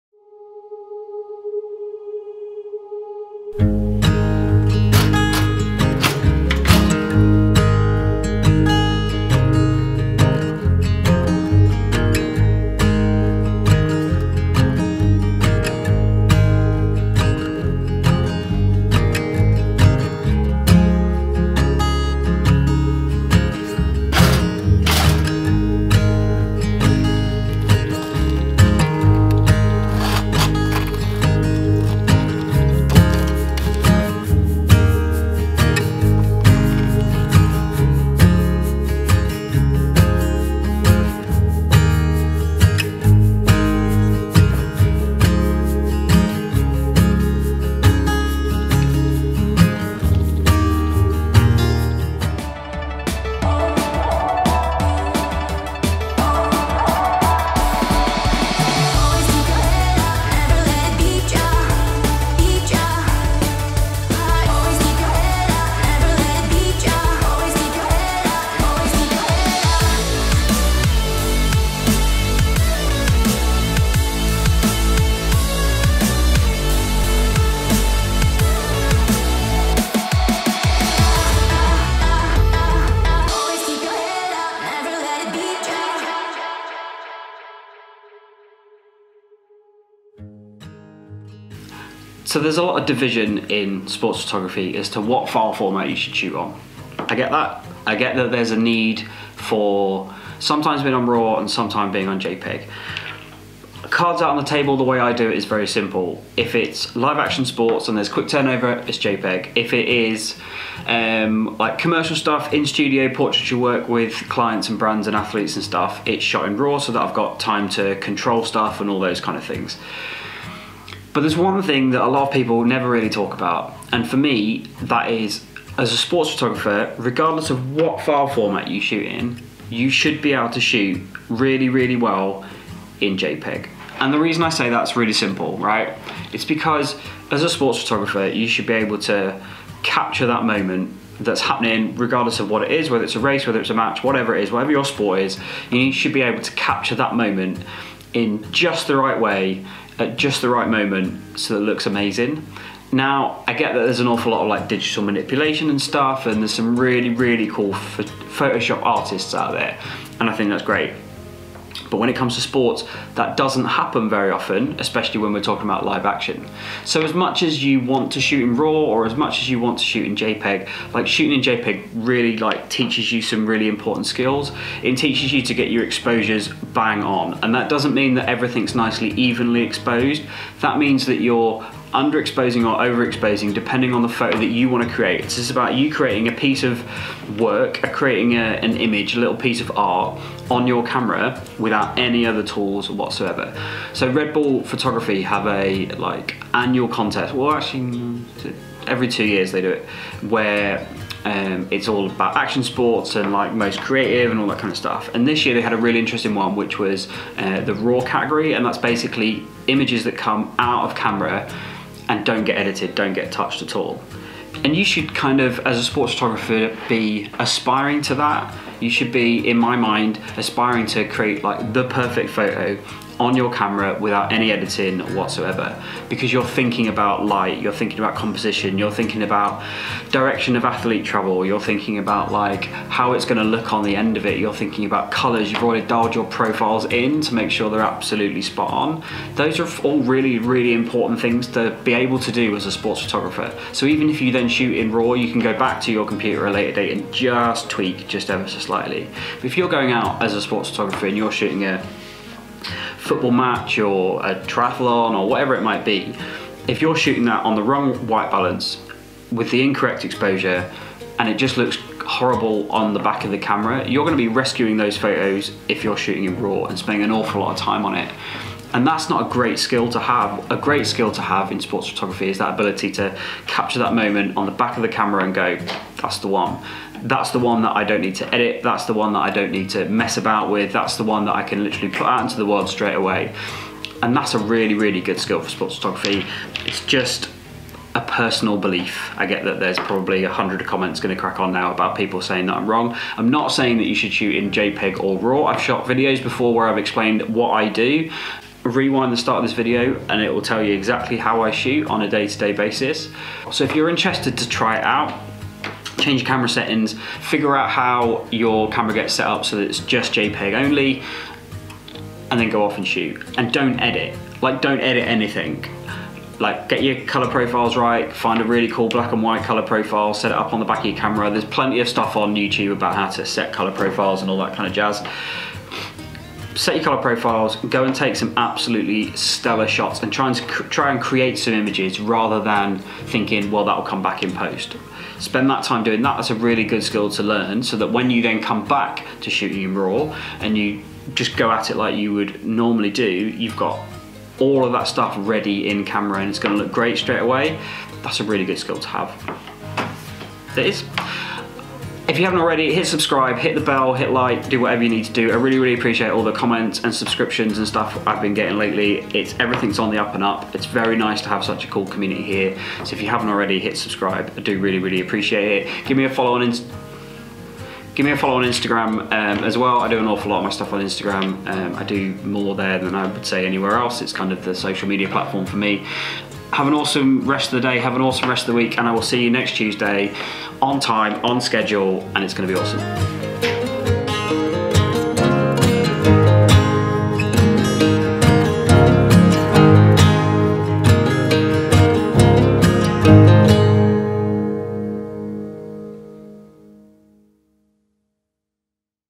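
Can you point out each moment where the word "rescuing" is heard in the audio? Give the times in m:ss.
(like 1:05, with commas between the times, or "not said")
4:24.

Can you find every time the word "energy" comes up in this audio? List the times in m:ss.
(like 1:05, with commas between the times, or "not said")
not said.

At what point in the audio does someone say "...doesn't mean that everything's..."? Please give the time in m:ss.
2:57.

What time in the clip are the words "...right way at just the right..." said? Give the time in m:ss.
2:28.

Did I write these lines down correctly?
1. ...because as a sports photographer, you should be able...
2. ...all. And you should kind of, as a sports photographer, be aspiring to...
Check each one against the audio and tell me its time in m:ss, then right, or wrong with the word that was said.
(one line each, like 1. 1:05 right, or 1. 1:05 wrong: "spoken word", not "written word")
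1. 2:16 right
2. 3:33 right.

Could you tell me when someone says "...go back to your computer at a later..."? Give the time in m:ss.
4:05.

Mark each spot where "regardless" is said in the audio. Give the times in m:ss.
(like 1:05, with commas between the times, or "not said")
2:06, 2:21.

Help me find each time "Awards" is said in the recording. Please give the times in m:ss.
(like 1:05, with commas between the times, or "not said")
not said.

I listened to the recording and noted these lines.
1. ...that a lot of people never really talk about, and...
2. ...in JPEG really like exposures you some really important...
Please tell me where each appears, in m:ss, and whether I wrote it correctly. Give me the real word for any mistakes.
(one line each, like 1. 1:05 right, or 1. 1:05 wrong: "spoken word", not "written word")
1. 2:01 right
2. 2:51 wrong: "teaches", not "exposures".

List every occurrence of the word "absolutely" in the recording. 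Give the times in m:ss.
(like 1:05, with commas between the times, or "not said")
3:57, 5:28.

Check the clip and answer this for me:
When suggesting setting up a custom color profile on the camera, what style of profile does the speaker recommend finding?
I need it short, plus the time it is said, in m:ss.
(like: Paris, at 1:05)
black and white, at 5:18.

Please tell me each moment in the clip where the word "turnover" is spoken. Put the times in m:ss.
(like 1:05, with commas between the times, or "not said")
1:48.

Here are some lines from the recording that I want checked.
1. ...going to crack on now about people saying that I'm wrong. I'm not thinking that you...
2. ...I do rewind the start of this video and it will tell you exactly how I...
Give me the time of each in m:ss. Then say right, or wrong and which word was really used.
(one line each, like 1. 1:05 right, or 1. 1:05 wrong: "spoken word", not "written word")
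1. 4:51 wrong: "saying", not "thinking"
2. 4:57 right.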